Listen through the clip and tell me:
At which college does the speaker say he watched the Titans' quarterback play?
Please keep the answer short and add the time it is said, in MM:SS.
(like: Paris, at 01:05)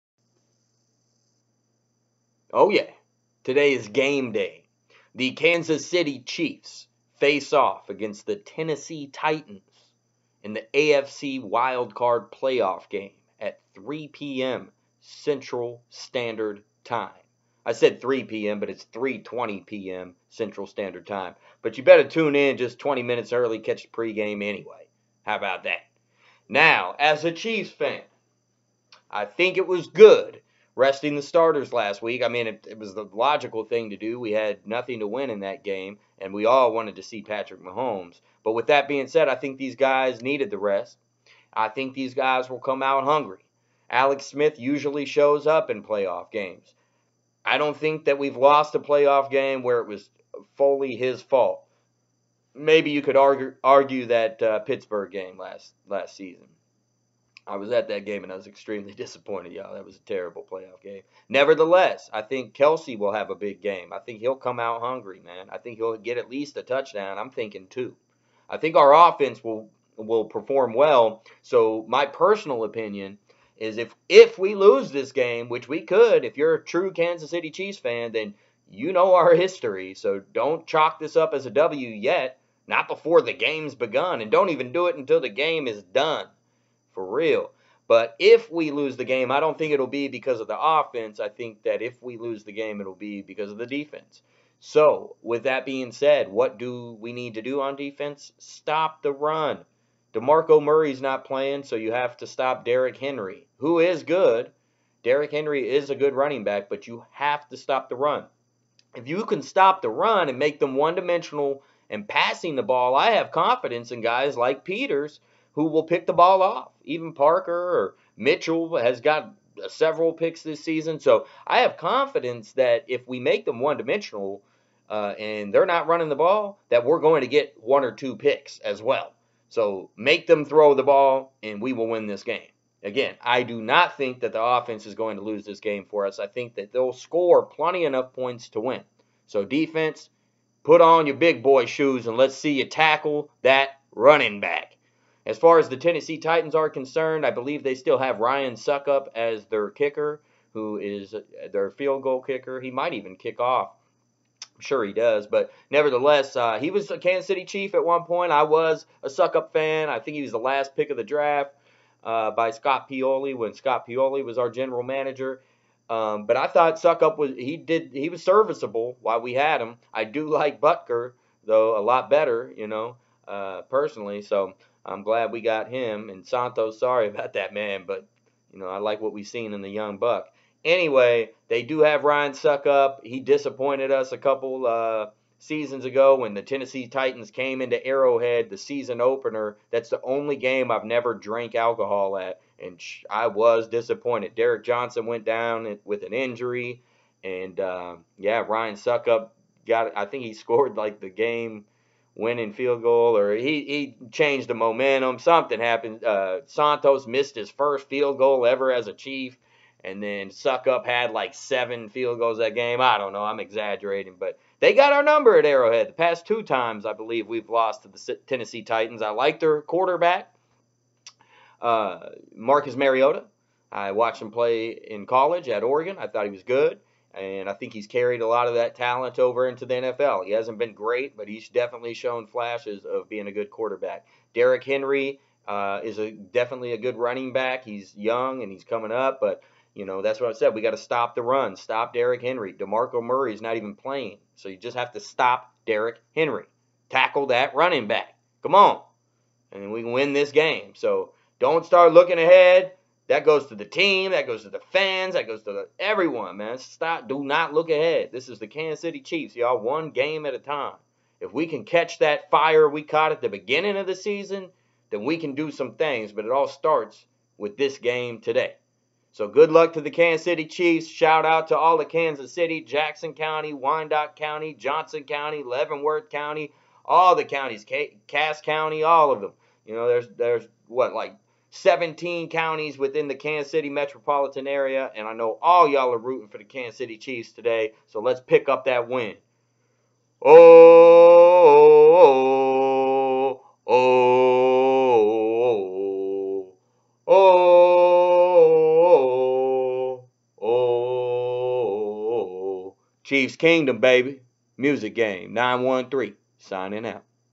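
Oregon, at 03:45.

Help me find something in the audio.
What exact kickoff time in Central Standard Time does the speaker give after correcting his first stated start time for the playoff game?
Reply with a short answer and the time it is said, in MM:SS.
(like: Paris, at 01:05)
3:20 p.m., at 00:18.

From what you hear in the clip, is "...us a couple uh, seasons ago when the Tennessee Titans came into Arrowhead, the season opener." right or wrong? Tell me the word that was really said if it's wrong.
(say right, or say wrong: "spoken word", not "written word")
right.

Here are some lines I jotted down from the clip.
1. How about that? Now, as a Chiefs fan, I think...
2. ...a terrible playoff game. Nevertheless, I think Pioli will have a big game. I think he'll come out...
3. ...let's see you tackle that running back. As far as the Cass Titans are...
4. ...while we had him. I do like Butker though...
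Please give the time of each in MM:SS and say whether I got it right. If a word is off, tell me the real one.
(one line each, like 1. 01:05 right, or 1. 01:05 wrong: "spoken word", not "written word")
1. 00:25 right
2. 00:59 wrong: "Kelce", not "Pioli"
3. 02:22 wrong: "Tennessee", not "Cass"
4. 02:49 right.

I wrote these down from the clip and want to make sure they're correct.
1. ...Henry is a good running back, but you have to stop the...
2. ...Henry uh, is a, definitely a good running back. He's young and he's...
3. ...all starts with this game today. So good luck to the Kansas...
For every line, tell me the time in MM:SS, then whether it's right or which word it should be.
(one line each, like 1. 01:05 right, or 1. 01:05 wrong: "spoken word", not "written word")
1. 01:45 right
2. 03:54 right
3. 04:26 right.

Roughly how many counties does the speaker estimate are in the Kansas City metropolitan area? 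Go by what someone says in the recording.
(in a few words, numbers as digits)
17.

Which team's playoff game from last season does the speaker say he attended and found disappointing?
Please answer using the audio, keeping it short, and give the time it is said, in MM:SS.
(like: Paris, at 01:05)
Pittsburgh, at 00:54.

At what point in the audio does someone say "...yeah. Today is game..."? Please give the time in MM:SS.
00:02.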